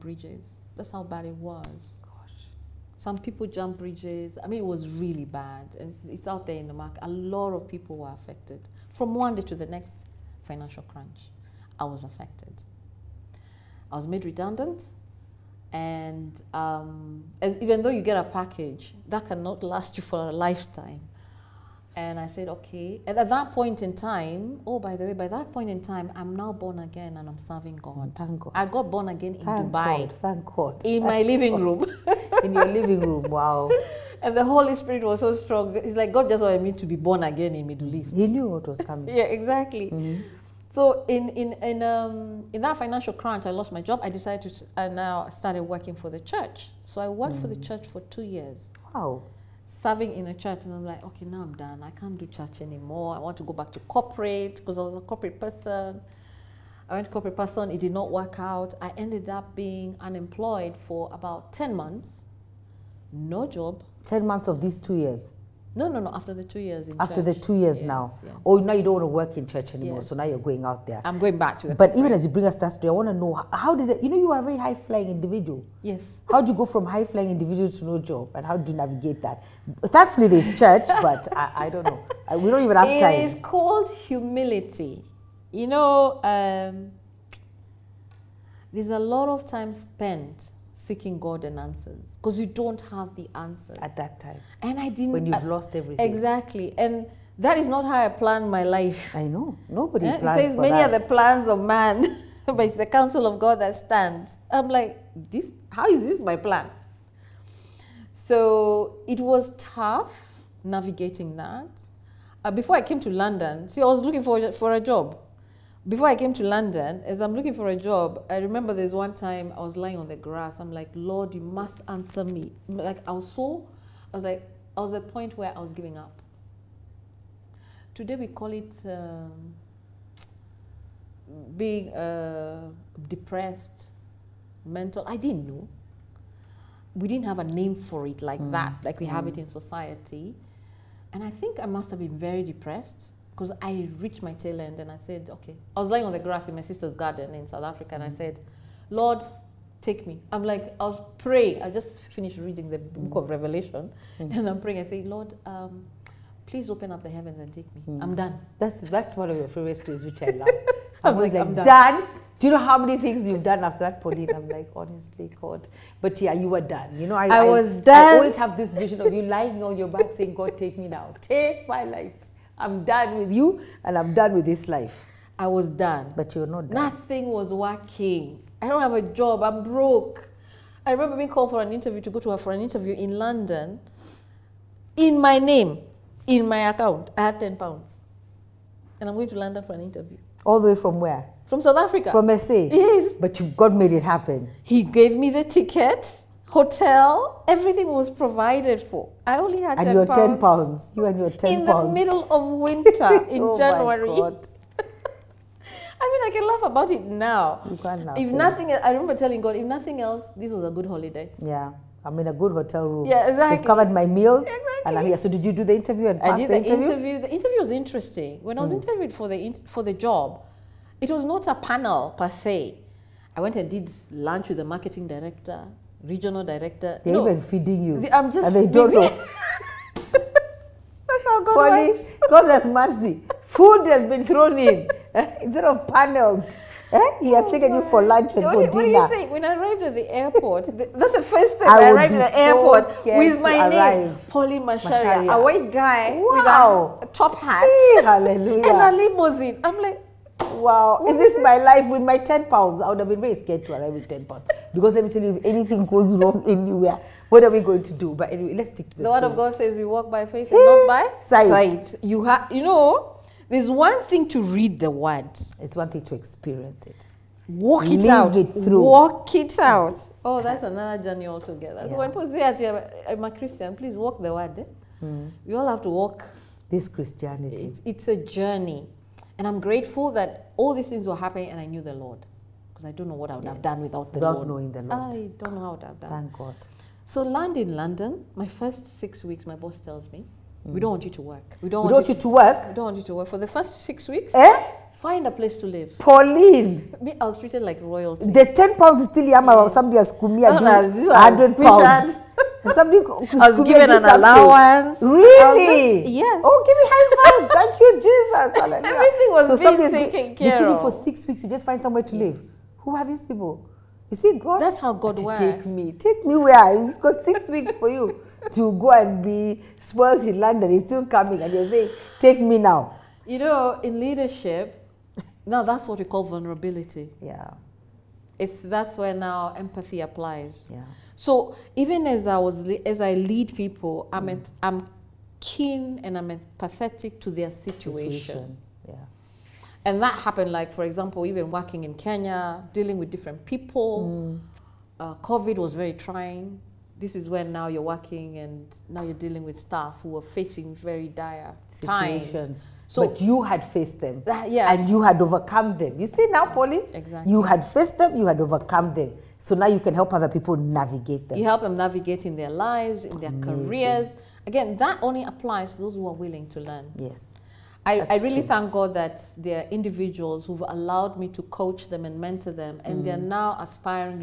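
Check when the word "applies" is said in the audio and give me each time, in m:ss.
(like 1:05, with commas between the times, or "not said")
5:30, 6:05.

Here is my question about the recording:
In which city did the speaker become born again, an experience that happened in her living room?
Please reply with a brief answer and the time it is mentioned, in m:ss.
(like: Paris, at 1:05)
Dubai, at 0:29.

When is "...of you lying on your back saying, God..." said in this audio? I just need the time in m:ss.
2:49.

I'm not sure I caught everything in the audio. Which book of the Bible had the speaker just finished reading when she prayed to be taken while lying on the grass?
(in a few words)
Revelation.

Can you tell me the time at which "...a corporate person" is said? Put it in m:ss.
0:54.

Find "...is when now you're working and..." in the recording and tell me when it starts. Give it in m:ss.
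5:47.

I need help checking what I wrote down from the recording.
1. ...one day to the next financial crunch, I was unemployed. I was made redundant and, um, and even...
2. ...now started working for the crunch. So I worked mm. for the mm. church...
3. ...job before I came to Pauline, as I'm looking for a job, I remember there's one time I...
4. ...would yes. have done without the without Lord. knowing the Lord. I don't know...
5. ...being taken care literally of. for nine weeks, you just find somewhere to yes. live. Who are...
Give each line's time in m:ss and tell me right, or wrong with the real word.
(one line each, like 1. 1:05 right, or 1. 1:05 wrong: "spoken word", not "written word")
1. 0:09 wrong: "affected", not "unemployed"
2. 0:44 wrong: "church", not "crunch"
3. 1:54 wrong: "London", not "Pauline"
4. 4:43 right
5. 5:09 wrong: "six", not "nine".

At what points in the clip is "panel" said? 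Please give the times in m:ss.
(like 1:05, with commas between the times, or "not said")
3:41, 3:55.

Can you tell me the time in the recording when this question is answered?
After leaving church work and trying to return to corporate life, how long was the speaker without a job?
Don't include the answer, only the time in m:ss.
1:01.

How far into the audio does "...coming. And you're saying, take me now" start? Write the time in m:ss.
5:21.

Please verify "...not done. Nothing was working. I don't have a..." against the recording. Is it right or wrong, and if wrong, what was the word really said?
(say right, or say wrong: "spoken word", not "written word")
right.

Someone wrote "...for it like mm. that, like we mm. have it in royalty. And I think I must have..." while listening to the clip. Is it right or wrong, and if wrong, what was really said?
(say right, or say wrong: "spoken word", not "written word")
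wrong: "society", not "royalty".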